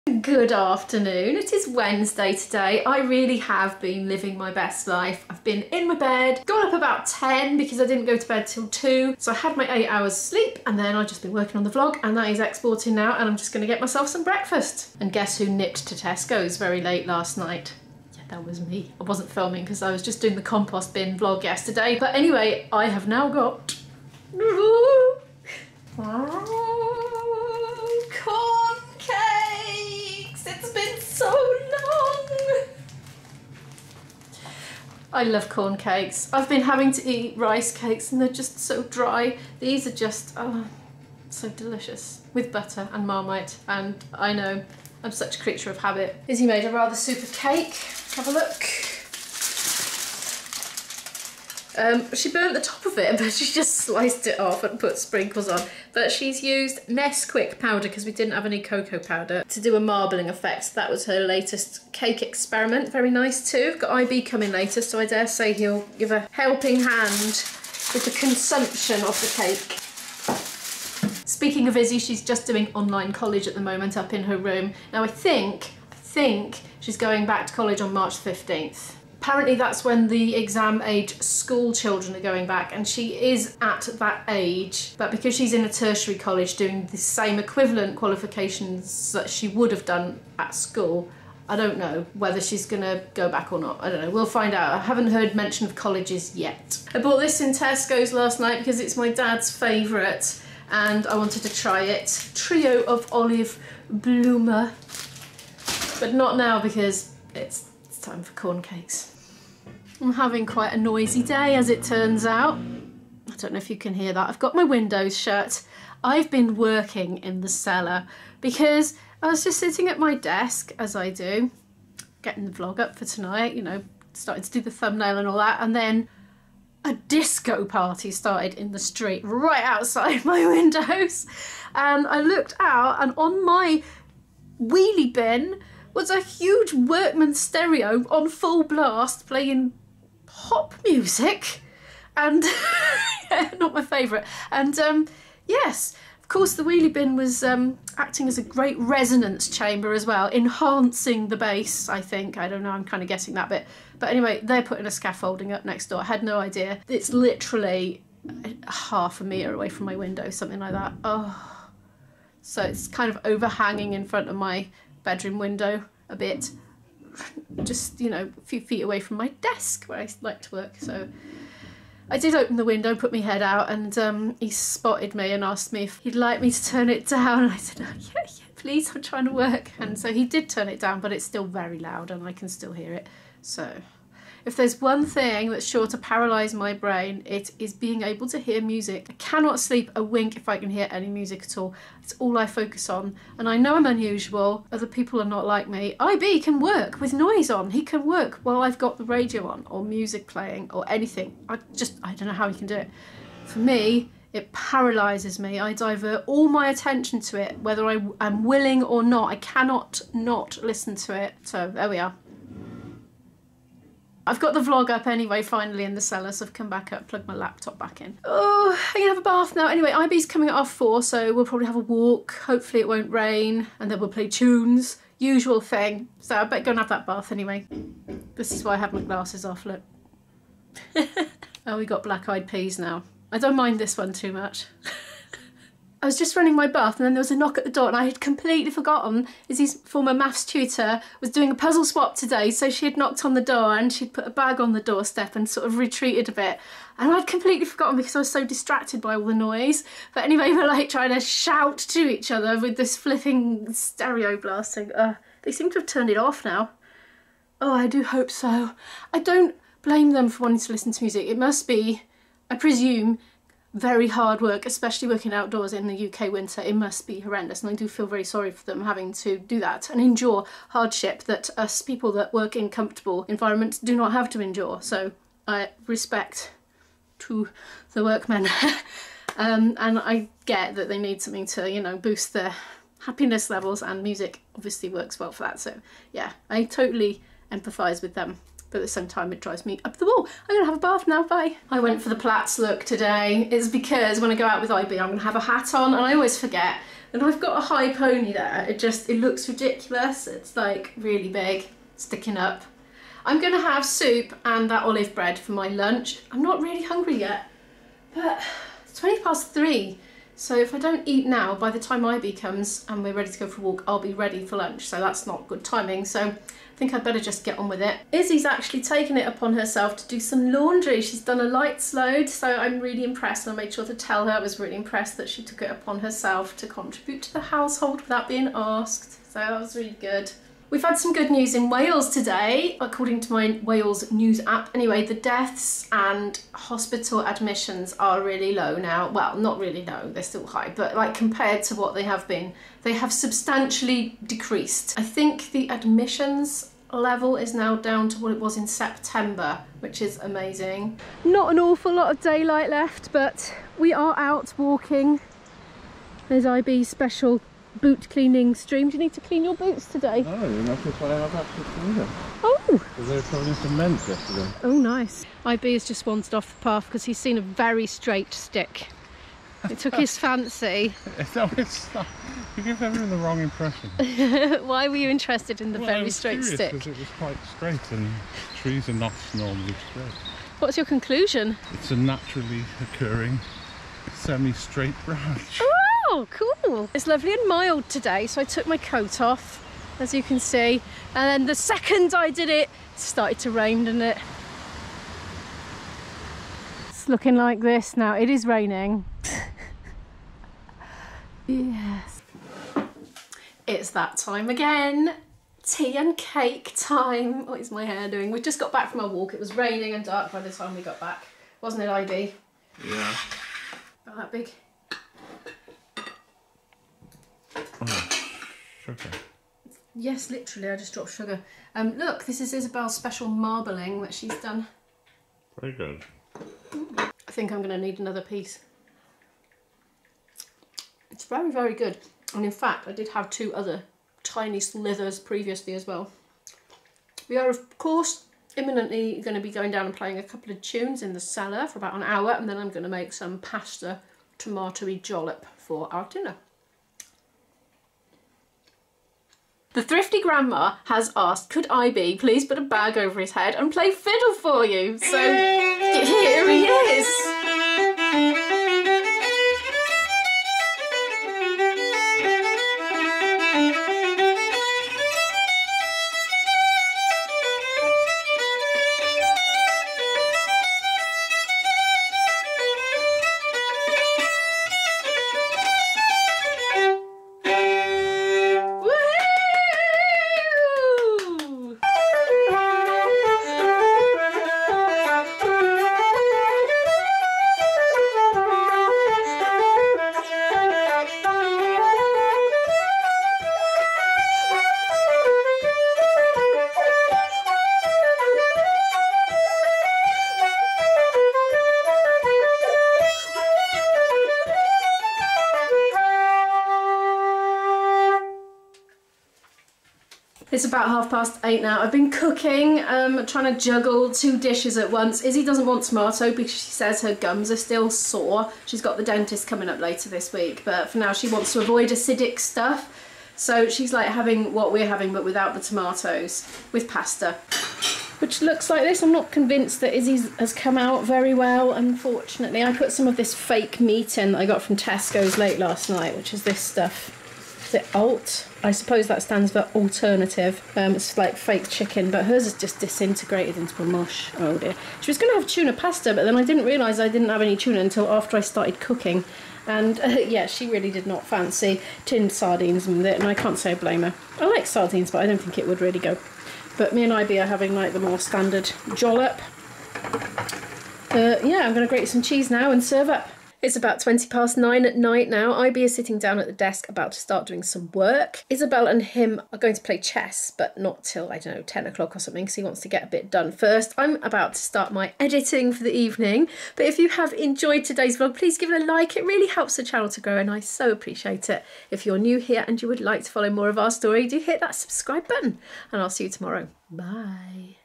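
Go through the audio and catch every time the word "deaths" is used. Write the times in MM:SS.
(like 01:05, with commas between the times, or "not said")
05:35.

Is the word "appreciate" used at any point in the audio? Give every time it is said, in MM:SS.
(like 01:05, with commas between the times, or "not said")
09:40.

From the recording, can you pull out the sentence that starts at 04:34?
So I respect to the workmen.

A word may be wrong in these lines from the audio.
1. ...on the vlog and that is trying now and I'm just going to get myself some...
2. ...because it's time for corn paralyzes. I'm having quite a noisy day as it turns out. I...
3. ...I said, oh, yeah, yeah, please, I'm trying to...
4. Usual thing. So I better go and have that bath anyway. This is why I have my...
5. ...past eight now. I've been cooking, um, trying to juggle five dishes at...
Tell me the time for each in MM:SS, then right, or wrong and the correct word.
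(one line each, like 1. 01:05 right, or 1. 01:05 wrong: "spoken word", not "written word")
1. 00:11 wrong: "exporting", not "trying"
2. 01:46 wrong: "cakes", not "paralyzes"
3. 02:57 right
4. 03:45 right
5. 08:31 wrong: "two", not "five".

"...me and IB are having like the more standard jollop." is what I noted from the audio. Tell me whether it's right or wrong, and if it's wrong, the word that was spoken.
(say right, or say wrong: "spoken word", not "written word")
right.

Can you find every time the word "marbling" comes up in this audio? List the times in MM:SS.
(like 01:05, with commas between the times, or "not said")
00:59, 07:03.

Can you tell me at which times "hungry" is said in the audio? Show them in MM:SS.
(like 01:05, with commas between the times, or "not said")
05:06.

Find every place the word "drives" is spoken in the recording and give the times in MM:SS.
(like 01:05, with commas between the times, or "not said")
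04:49.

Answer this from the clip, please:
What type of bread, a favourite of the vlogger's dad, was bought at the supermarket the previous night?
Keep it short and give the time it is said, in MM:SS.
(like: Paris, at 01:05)
Trio of Olive Bloomer, at 01:42.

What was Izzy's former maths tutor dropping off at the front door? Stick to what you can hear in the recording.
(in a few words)
A puzzle swap.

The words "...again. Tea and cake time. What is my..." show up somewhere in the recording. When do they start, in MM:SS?
06:44.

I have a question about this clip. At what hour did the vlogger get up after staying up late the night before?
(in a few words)
10.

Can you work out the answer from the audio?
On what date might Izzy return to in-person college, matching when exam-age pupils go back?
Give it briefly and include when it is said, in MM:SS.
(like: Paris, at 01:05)
March 15th, at 01:17.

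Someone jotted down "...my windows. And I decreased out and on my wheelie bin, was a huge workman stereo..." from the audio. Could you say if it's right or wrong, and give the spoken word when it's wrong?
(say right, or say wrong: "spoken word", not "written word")
wrong: "looked", not "decreased".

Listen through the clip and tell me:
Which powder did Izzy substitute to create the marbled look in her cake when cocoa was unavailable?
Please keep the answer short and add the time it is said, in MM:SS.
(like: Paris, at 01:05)
Nesquik, at 00:56.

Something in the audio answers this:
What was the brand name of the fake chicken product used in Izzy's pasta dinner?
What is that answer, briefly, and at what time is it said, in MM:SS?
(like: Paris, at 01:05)
The Alt, at 08:57.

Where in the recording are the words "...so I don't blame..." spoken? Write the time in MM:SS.
04:18.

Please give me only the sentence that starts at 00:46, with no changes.
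Izzy made a rather super cake.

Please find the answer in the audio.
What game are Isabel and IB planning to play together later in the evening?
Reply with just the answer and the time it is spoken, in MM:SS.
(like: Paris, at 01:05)
Chess, at 09:29.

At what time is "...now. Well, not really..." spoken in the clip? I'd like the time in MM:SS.
05:38.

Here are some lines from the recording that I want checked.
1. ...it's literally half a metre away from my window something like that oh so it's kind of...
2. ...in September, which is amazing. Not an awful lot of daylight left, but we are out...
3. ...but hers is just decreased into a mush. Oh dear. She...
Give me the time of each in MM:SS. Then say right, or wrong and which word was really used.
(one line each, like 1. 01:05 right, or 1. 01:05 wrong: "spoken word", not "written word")
1. 02:36 right
2. 05:48 right
3. 09:02 wrong: "disintegrated", not "decreased".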